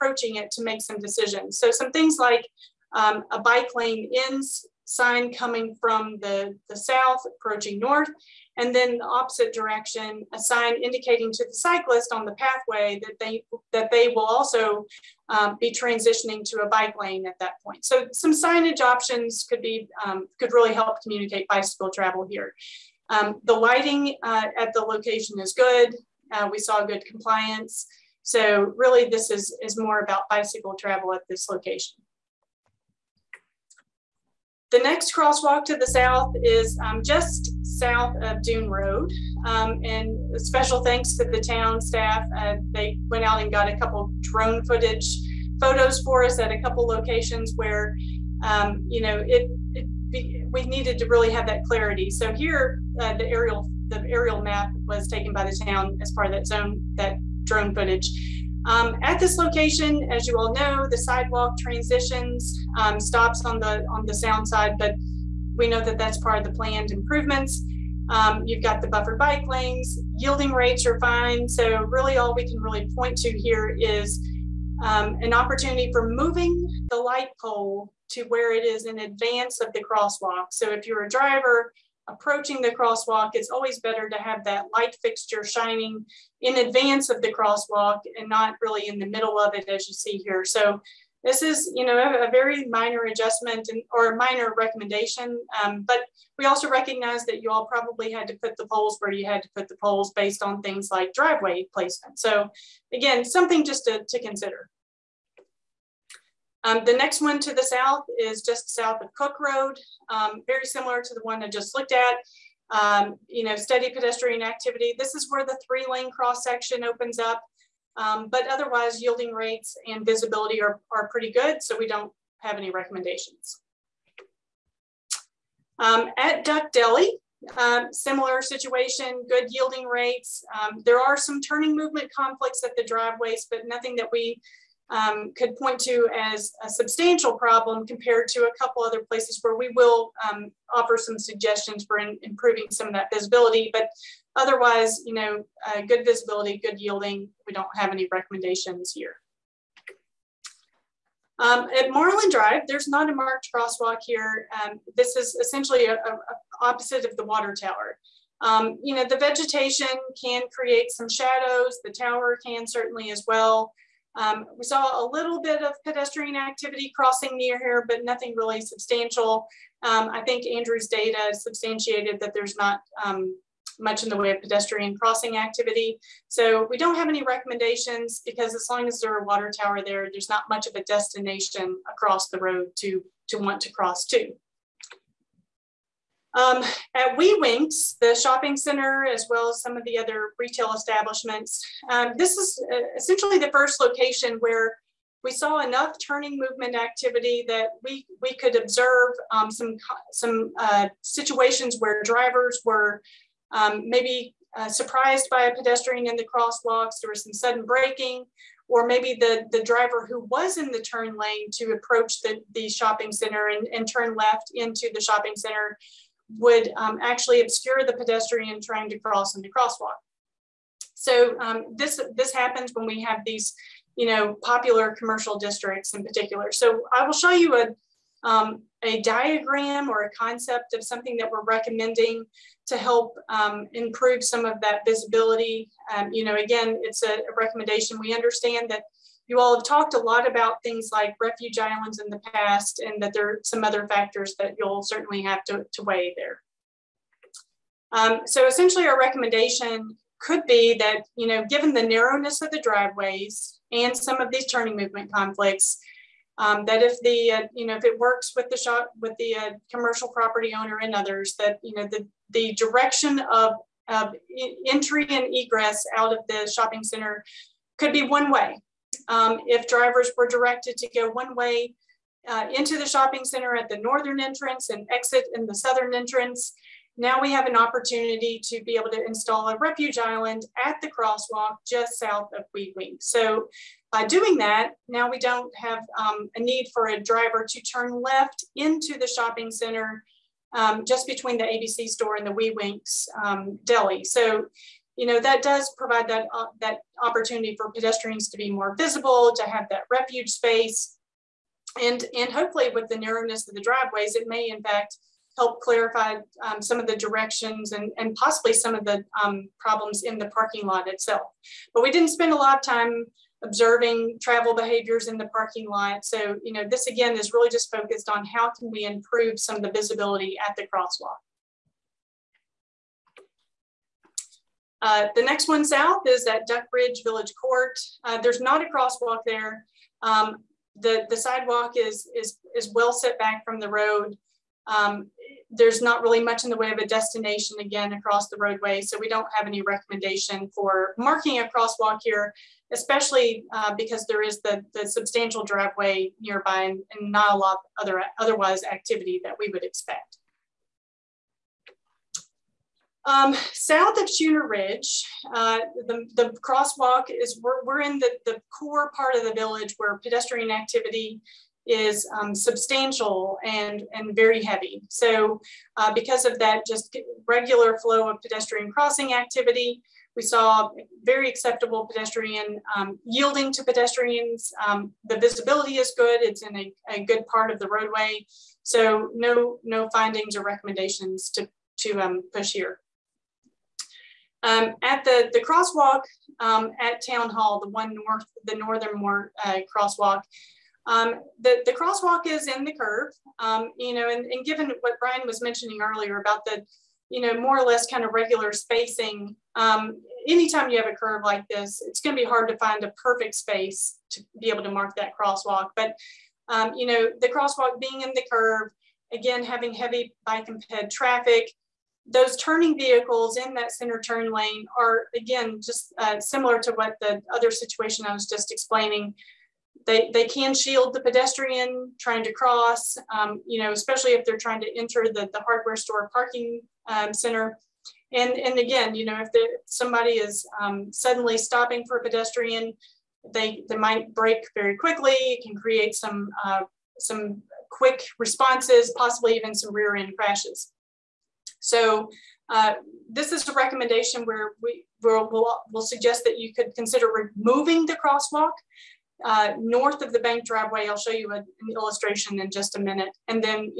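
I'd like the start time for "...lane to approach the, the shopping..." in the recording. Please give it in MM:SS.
03:31.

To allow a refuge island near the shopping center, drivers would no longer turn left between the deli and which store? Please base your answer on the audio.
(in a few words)
ABC store.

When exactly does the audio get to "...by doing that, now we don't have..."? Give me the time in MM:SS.
04:43.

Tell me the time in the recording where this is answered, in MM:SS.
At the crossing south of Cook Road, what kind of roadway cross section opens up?
01:55.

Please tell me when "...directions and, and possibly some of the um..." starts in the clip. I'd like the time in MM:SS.
05:06.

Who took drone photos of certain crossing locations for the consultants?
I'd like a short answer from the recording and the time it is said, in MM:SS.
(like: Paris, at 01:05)
The town staff, at 00:41.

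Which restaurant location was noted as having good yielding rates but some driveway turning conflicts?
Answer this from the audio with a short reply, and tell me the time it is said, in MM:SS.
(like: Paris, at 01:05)
Duck Deli, at 02:06.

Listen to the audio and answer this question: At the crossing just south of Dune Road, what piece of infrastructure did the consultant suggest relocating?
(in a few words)
The light pole.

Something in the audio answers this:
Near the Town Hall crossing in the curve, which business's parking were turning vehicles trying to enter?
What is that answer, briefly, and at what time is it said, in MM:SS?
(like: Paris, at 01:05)
The hardware store, at 07:05.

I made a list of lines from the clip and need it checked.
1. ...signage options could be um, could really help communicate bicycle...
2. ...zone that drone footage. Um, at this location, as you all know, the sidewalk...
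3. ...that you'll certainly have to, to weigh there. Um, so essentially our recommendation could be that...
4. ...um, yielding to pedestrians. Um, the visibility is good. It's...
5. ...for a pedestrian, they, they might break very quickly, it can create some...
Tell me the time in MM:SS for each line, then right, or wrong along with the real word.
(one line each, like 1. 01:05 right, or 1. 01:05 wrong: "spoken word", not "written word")
1. 00:18 right
2. 00:56 right
3. 04:04 right
4. 06:12 right
5. 07:11 right.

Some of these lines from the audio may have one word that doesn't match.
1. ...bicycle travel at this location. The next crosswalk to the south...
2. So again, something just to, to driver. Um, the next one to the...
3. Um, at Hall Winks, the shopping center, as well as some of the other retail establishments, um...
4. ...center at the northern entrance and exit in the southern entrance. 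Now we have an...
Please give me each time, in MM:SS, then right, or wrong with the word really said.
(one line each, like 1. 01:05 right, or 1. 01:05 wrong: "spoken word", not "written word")
1. 00:30 right
2. 01:42 wrong: "consider", not "driver"
3. 03:06 wrong: "Wee", not "Hall"
4. 04:33 right.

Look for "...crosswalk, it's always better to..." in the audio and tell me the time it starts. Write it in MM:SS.
01:22.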